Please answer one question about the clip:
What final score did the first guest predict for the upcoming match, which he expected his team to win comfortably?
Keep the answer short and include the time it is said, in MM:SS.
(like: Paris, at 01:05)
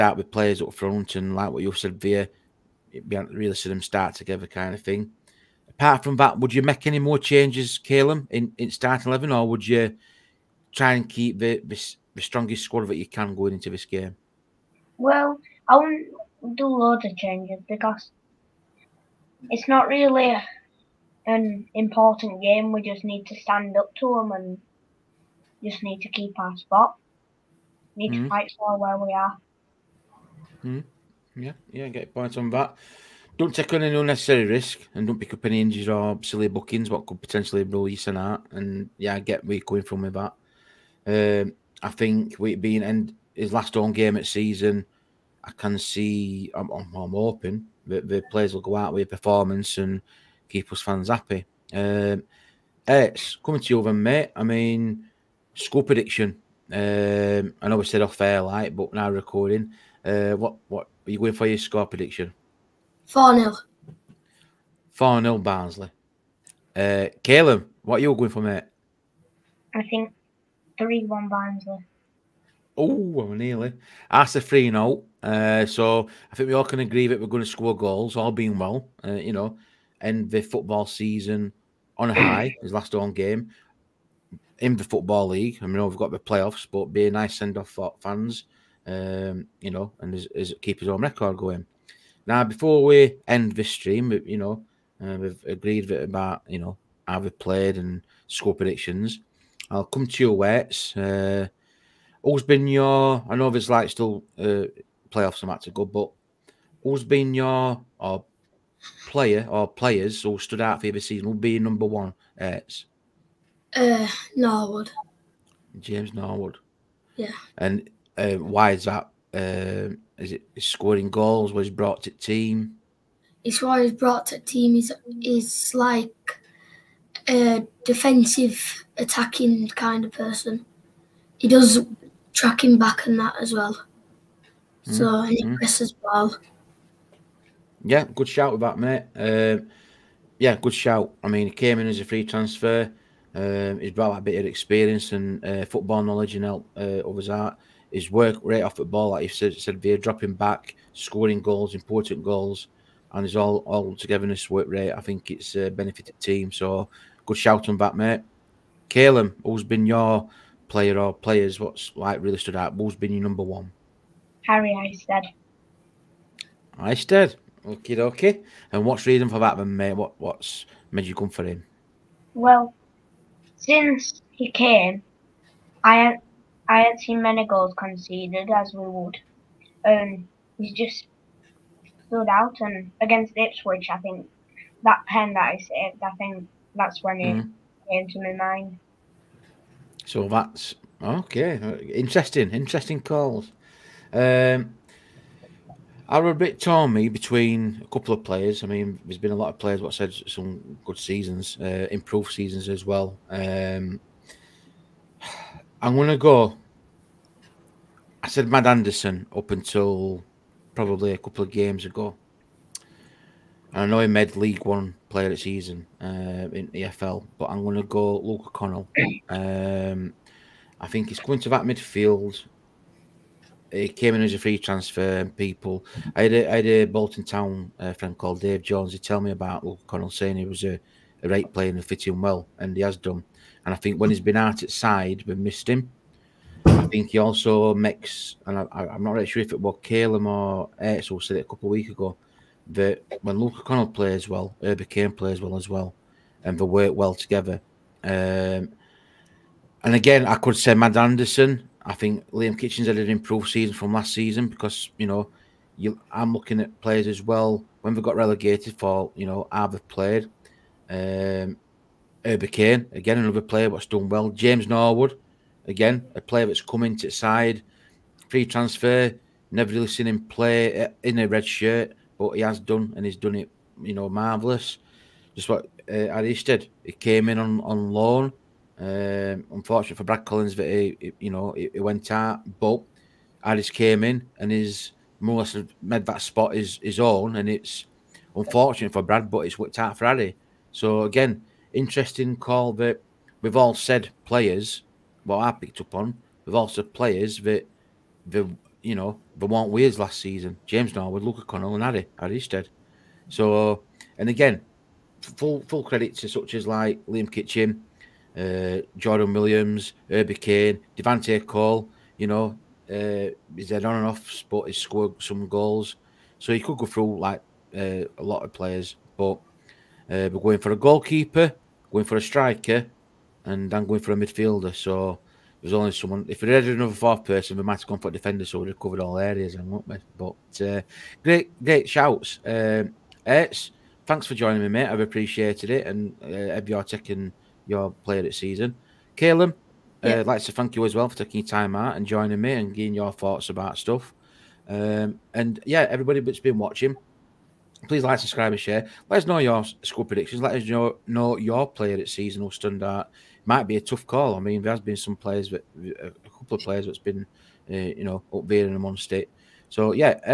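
4-0, at 01:03.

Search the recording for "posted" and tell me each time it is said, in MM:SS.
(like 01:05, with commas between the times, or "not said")
not said.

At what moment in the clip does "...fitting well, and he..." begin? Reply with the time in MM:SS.
03:51.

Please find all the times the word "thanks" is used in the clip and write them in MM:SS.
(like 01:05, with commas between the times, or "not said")
05:34, 05:40.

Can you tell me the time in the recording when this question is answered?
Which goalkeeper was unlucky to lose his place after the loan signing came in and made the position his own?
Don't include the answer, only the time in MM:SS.
04:40.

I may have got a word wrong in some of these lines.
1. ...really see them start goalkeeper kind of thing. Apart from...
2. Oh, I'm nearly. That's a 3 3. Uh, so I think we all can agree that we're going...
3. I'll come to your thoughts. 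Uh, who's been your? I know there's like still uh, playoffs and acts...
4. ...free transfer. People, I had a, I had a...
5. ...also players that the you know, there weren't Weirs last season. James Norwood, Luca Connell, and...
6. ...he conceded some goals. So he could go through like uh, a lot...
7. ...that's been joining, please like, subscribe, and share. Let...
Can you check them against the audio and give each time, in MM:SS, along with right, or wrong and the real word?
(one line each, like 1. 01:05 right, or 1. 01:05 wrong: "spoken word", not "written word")
1. 00:03 wrong: "together", not "goalkeeper"
2. 01:12 wrong: "0", not "3"
3. 01:39 wrong: "weights", not "thoughts"
4. 03:44 right
5. 04:56 right
6. 05:14 wrong: "scored", not "conceded"
7. 05:46 wrong: "watching", not "joining".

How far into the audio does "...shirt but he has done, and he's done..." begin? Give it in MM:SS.
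04:31.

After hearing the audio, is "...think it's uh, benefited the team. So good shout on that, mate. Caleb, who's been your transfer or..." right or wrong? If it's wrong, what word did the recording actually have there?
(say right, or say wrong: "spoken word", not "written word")
wrong: "player", not "transfer".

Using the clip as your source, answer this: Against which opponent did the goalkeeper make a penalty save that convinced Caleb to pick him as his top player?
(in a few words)
Ipswich.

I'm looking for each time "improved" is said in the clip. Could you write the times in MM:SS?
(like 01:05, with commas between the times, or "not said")
03:21, 04:13.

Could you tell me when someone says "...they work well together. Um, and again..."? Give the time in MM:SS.
04:06.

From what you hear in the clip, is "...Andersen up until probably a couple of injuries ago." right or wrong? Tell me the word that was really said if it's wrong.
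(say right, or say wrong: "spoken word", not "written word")
wrong: "games", not "injuries".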